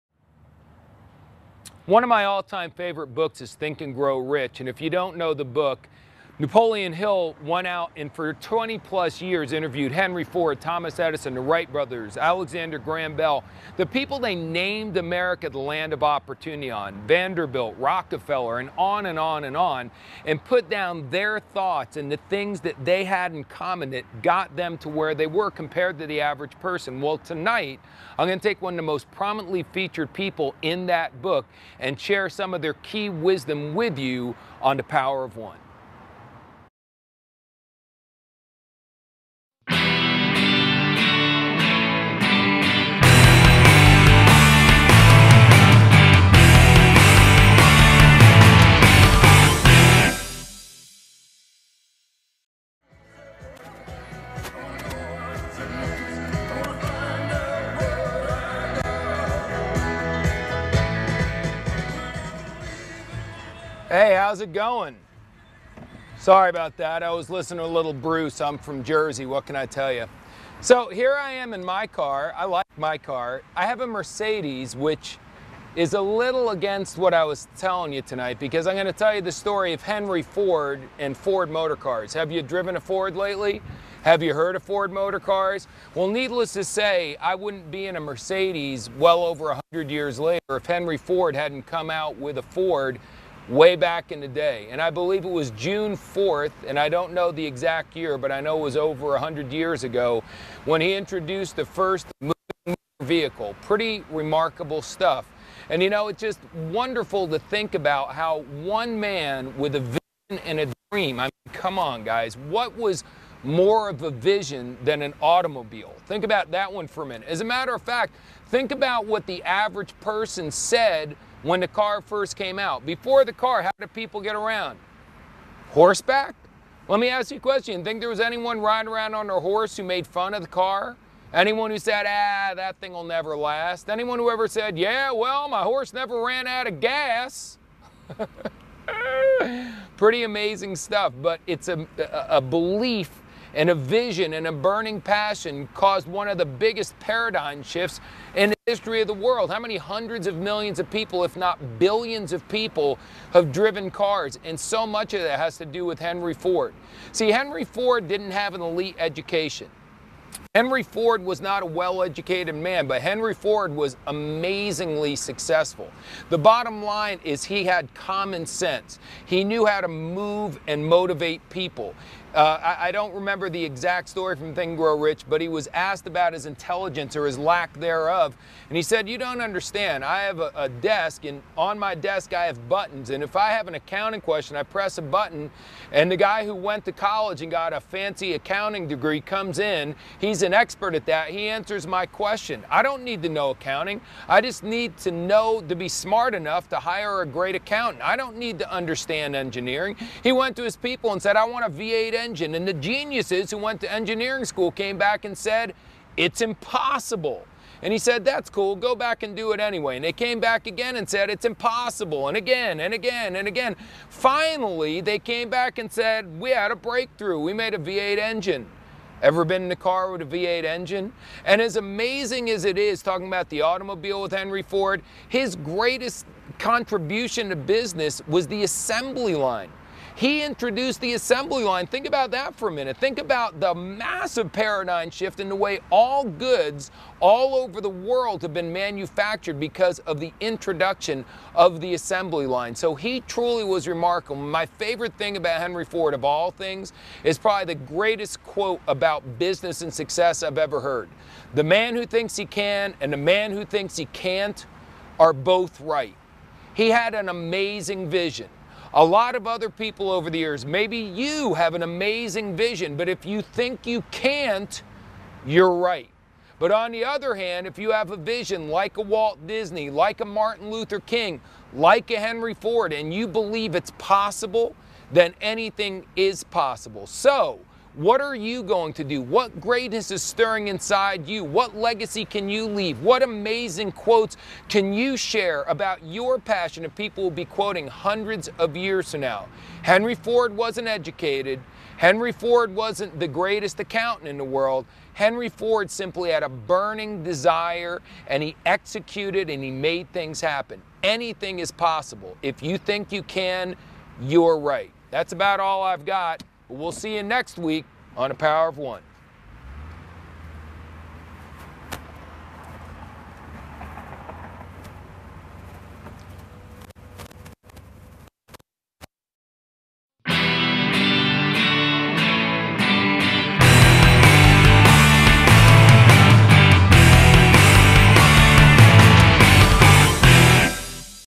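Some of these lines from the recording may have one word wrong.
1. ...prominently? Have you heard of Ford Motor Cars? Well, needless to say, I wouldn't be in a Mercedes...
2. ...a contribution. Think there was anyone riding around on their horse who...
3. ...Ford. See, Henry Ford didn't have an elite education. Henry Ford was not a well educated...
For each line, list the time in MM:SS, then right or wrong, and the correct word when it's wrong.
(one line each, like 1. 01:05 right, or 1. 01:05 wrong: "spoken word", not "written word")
1. 01:23 wrong: "lately", not "prominently"
2. 02:07 wrong: "question", not "contribution"
3. 02:36 right.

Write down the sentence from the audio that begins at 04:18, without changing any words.
A lot of other people over the years, maybe you have an amazing vision, but if you think you can't, you're right.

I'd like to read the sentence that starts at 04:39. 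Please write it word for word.
What greatness is stirring inside you?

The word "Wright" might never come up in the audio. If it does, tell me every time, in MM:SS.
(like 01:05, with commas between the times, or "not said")
00:11.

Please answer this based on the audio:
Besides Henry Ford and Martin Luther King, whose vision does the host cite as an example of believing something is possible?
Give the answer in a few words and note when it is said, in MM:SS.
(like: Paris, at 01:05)
Walt Disney, at 04:29.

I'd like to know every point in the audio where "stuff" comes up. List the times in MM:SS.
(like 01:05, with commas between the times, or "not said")
01:44, 02:20.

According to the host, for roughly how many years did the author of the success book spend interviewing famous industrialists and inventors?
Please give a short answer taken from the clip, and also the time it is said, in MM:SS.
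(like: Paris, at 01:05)
20 plus years, at 00:08.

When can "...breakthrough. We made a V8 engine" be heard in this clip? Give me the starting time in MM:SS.
03:36.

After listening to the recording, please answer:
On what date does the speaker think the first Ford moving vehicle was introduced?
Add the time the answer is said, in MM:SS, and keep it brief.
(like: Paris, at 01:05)
June 4th, at 01:35.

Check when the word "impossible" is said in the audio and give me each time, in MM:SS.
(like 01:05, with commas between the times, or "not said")
03:26, 03:31.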